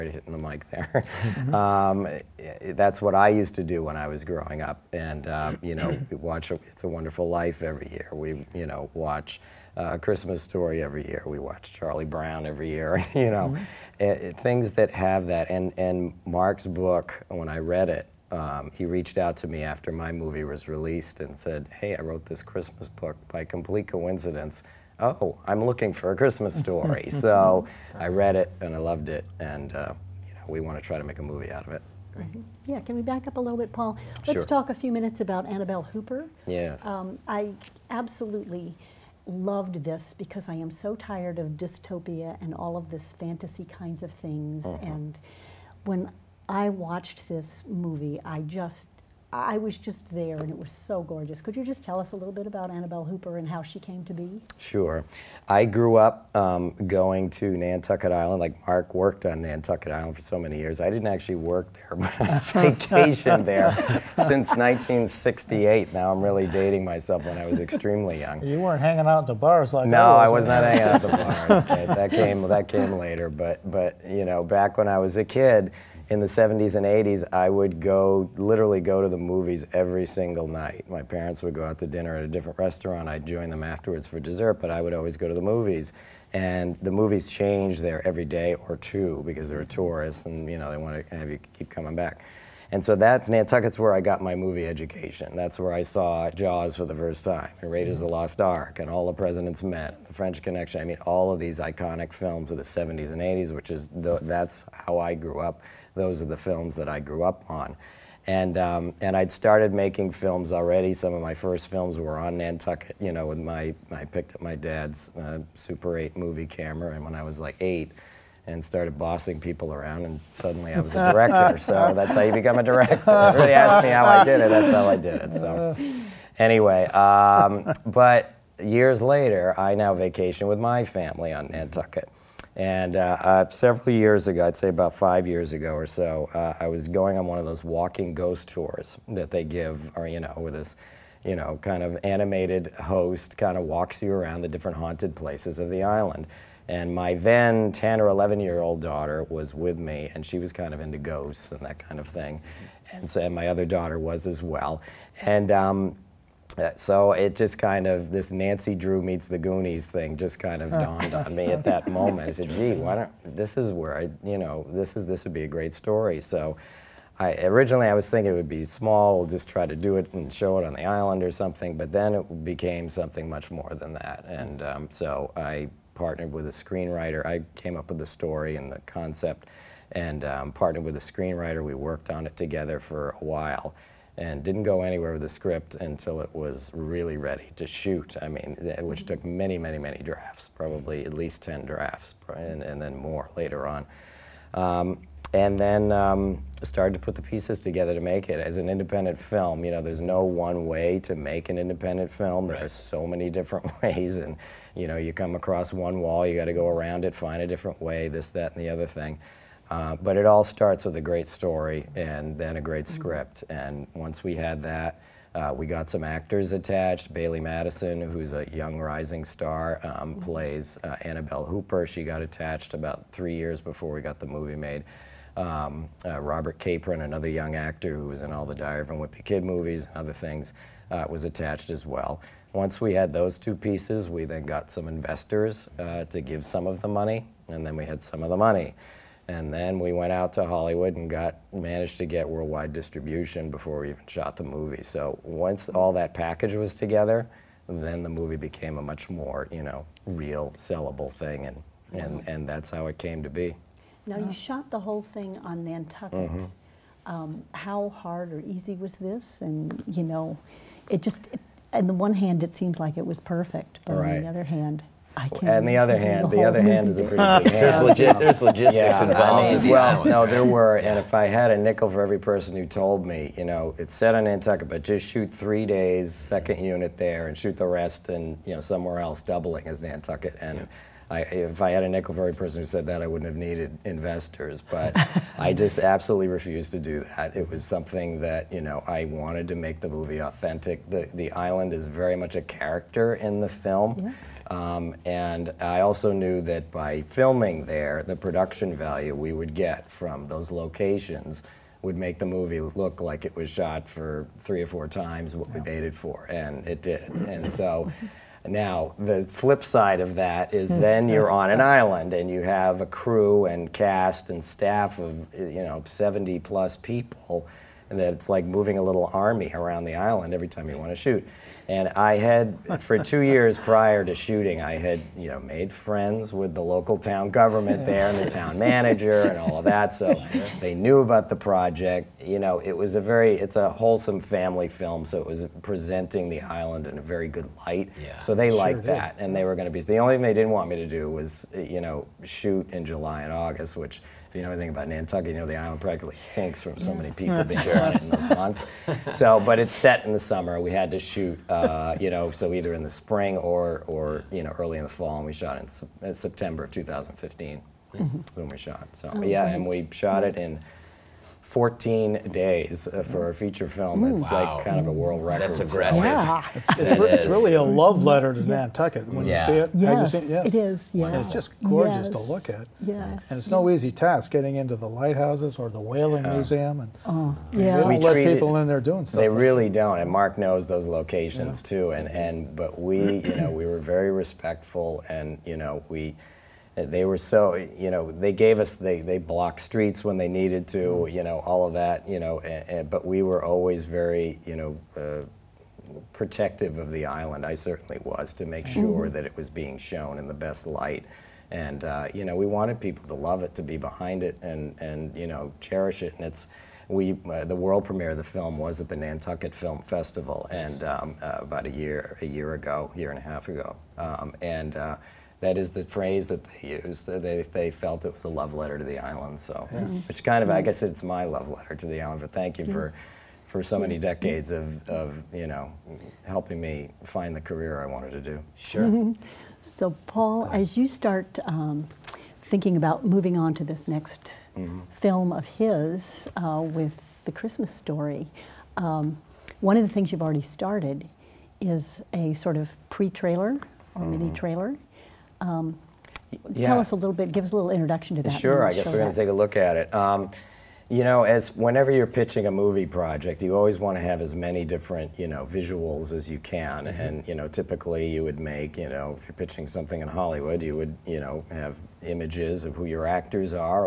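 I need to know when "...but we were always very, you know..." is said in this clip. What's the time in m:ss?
6:32.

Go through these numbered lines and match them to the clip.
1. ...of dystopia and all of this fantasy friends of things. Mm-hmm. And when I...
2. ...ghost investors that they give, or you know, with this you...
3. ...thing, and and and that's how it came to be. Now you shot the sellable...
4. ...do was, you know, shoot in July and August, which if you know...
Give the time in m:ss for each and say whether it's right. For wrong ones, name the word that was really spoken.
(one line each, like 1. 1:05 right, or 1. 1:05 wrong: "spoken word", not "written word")
1. 0:41 wrong: "kinds", not "friends"
2. 2:18 wrong: "tours", not "investors"
3. 4:11 wrong: "whole", not "sellable"
4. 5:40 right.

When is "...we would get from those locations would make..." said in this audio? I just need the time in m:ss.
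4:59.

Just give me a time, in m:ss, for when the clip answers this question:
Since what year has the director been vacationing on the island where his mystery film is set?
1:04.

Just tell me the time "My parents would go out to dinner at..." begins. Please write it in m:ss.
1:20.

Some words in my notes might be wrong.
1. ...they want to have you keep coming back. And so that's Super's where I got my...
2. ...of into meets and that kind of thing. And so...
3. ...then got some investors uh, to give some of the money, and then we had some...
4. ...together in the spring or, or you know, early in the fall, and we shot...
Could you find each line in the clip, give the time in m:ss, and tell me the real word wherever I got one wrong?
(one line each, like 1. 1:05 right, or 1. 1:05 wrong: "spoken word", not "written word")
1. 1:30 wrong: "Nantucket", not "Super"
2. 2:30 wrong: "ghosts", not "meets"
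3. 3:54 right
4. 5:52 wrong: "either", not "together".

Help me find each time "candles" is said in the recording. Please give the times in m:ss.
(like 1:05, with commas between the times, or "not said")
not said.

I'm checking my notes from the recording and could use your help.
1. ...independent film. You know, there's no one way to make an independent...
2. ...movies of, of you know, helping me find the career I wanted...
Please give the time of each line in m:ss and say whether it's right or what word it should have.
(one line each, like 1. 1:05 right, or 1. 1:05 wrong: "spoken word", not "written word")
1. 3:18 right
2. 7:03 wrong: "decades", not "movies".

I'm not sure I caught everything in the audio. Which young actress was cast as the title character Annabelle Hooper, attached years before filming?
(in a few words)
Bailee Madison.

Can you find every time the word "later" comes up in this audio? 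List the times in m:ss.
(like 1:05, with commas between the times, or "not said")
1:12, 2:09, 3:13.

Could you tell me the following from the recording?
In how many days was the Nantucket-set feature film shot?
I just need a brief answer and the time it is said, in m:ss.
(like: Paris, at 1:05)
14, at 6:01.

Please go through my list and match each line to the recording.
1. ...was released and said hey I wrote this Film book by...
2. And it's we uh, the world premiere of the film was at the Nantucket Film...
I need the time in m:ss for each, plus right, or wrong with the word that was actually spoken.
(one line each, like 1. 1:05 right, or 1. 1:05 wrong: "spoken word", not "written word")
1. 0:20 wrong: "Christmas", not "Film"
2. 6:46 right.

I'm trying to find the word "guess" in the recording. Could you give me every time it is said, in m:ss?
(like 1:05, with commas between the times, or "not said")
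7:00, 7:28.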